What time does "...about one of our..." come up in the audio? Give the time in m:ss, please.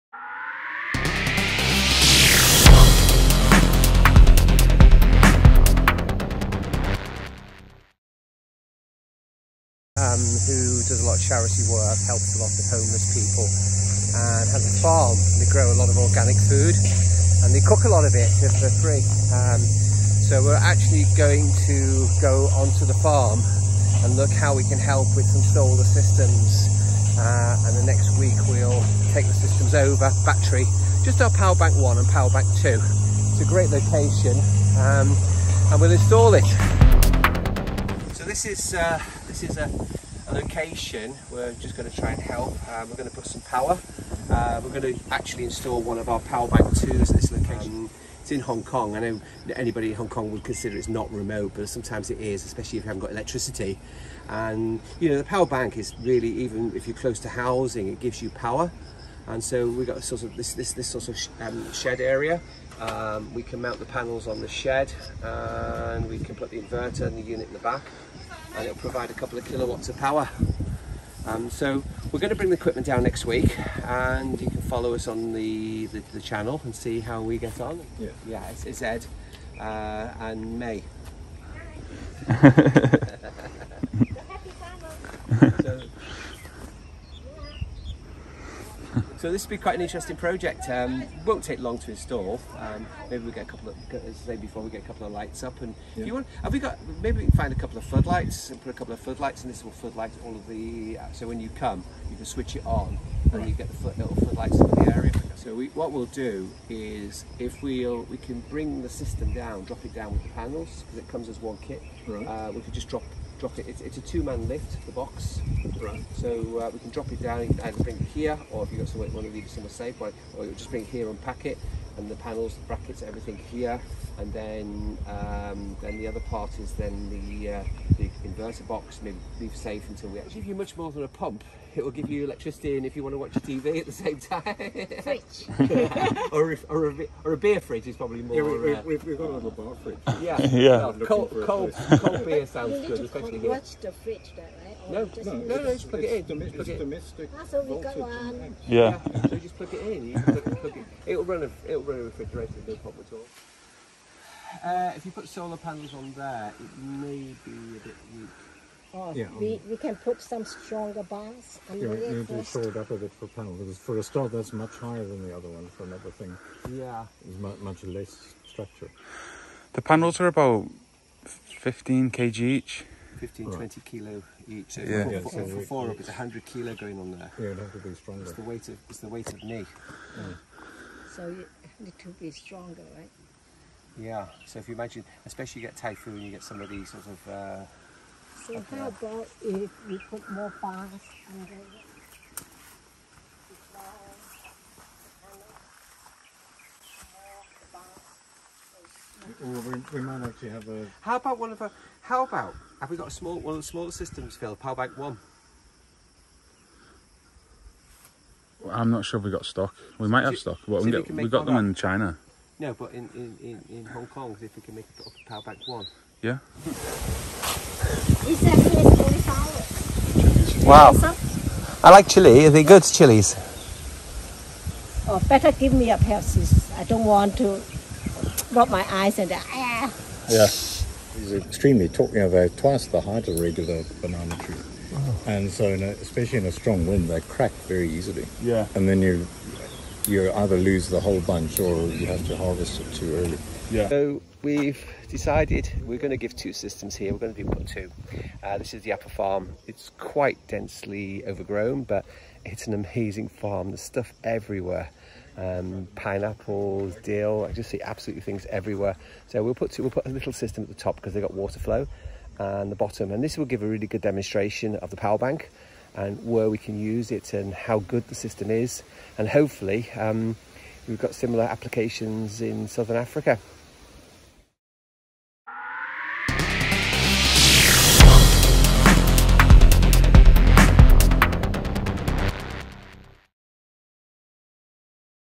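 3:21.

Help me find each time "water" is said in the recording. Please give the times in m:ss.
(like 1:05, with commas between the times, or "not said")
4:21.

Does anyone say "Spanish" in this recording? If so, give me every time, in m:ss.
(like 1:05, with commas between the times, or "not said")
not said.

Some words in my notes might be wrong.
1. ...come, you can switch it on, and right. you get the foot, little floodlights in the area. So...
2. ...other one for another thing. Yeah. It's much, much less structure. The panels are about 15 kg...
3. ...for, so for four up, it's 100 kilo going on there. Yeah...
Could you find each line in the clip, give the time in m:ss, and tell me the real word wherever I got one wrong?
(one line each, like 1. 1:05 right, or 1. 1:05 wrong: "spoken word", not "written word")
1. 1:41 right
2. 2:45 right
3. 2:55 right.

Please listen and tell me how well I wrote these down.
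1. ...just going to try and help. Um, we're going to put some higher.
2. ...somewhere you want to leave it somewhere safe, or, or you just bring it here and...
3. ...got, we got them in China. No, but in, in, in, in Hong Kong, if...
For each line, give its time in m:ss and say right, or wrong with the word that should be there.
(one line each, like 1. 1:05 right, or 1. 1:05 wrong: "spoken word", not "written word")
1. 0:41 wrong: "power", not "higher"
2. 1:58 right
3. 3:30 right.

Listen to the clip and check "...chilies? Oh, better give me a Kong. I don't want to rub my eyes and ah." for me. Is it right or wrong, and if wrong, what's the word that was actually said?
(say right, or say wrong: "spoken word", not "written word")
wrong: "Pepsi", not "Kong".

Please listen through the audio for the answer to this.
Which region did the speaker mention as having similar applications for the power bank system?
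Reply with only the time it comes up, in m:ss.
4:32.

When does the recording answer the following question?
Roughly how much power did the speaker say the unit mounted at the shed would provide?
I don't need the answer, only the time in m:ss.
1:09.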